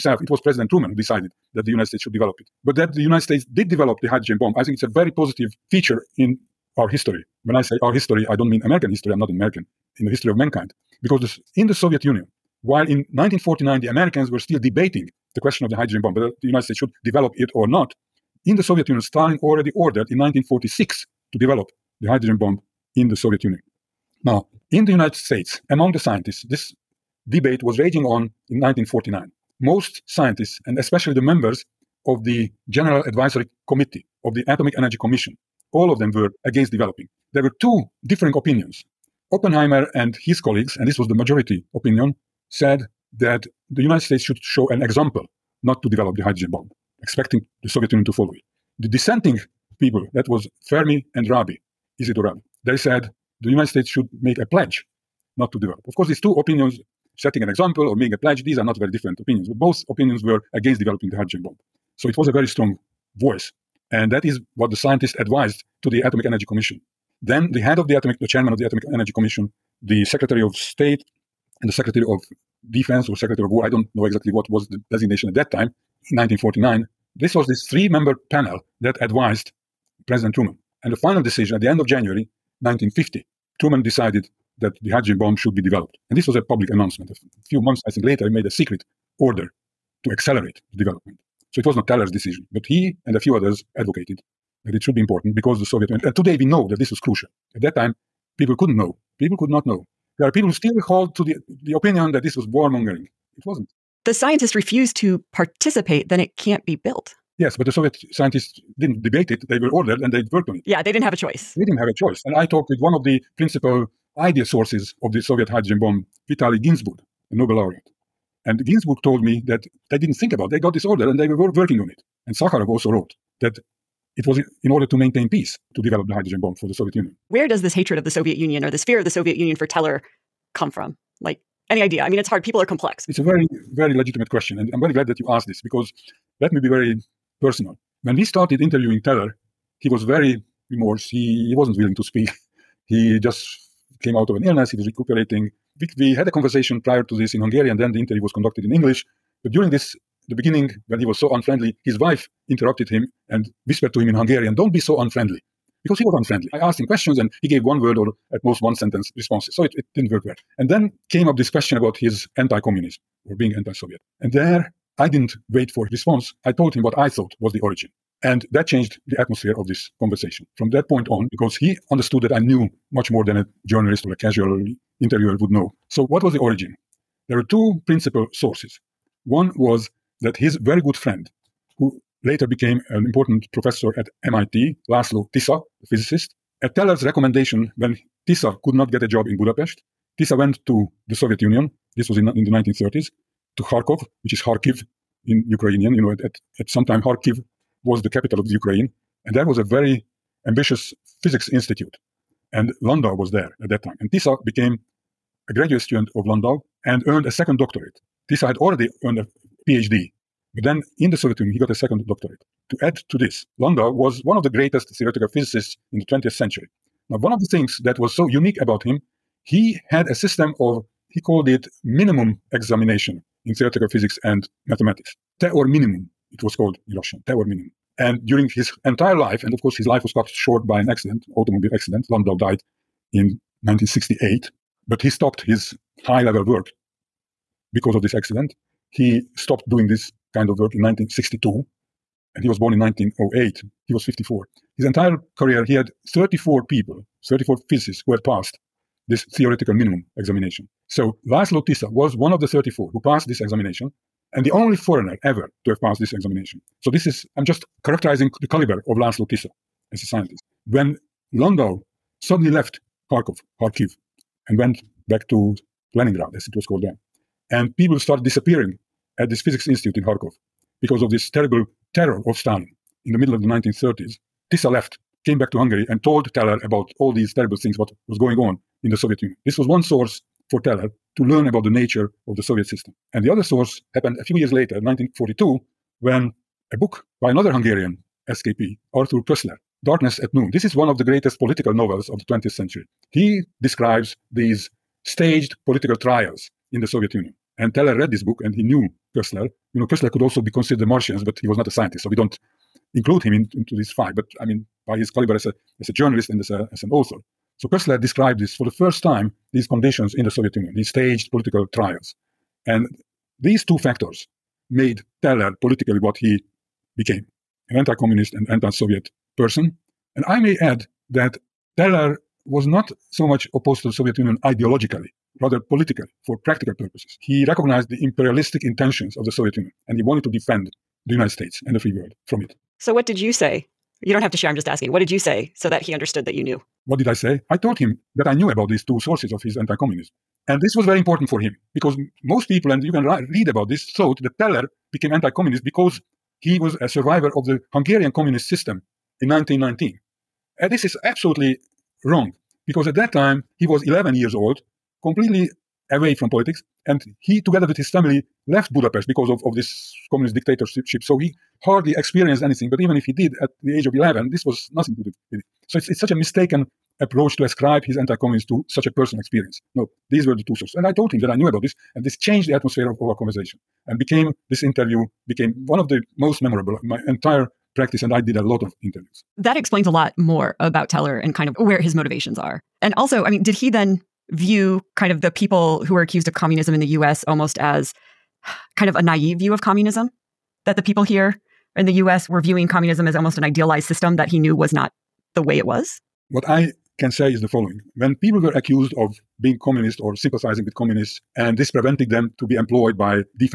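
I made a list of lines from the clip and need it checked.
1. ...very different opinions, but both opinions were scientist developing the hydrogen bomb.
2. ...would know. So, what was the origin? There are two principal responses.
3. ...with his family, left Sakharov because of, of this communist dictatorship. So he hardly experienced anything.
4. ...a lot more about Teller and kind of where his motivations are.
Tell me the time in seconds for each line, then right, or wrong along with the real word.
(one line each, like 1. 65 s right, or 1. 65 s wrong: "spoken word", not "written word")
1. 58 s wrong: "against", not "scientist"
2. 175 s wrong: "sources", not "responses"
3. 357 s wrong: "Budapest", not "Sakharov"
4. 379 s right.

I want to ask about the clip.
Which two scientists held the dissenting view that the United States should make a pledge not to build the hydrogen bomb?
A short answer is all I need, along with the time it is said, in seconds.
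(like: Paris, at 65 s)
Fermi and Rabi, at 50 s.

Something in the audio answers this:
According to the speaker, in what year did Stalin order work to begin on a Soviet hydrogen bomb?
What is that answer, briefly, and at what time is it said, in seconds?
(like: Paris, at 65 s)
1946, at 20 s.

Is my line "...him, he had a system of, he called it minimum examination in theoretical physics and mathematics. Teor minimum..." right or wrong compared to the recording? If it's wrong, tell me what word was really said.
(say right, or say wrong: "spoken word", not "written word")
right.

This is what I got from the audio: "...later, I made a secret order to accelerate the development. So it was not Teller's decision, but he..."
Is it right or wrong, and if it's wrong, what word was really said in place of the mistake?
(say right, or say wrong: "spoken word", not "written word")
right.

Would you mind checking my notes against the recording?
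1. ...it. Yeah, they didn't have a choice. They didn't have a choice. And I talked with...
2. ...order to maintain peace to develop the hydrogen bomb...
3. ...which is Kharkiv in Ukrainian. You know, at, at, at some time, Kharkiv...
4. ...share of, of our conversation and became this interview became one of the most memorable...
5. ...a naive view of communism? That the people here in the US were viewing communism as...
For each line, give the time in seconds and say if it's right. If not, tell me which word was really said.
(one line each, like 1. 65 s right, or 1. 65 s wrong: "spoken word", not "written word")
1. 110 s right
2. 124 s right
3. 194 s right
4. 372 s wrong: "atmosphere", not "share"
5. 388 s right.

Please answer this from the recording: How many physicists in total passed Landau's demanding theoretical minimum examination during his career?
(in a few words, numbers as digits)
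34.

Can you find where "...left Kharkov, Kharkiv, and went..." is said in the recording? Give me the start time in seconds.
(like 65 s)
262 s.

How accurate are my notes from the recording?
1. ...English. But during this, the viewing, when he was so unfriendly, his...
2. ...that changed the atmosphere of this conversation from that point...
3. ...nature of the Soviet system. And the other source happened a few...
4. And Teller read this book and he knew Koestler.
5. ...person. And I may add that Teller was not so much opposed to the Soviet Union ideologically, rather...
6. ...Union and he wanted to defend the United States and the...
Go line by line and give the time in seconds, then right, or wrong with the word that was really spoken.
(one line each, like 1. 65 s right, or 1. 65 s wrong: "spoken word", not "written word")
1. 148 s wrong: "beginning", not "viewing"
2. 168 s right
3. 281 s right
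4. 297 s right
5. 319 s right
6. 329 s right.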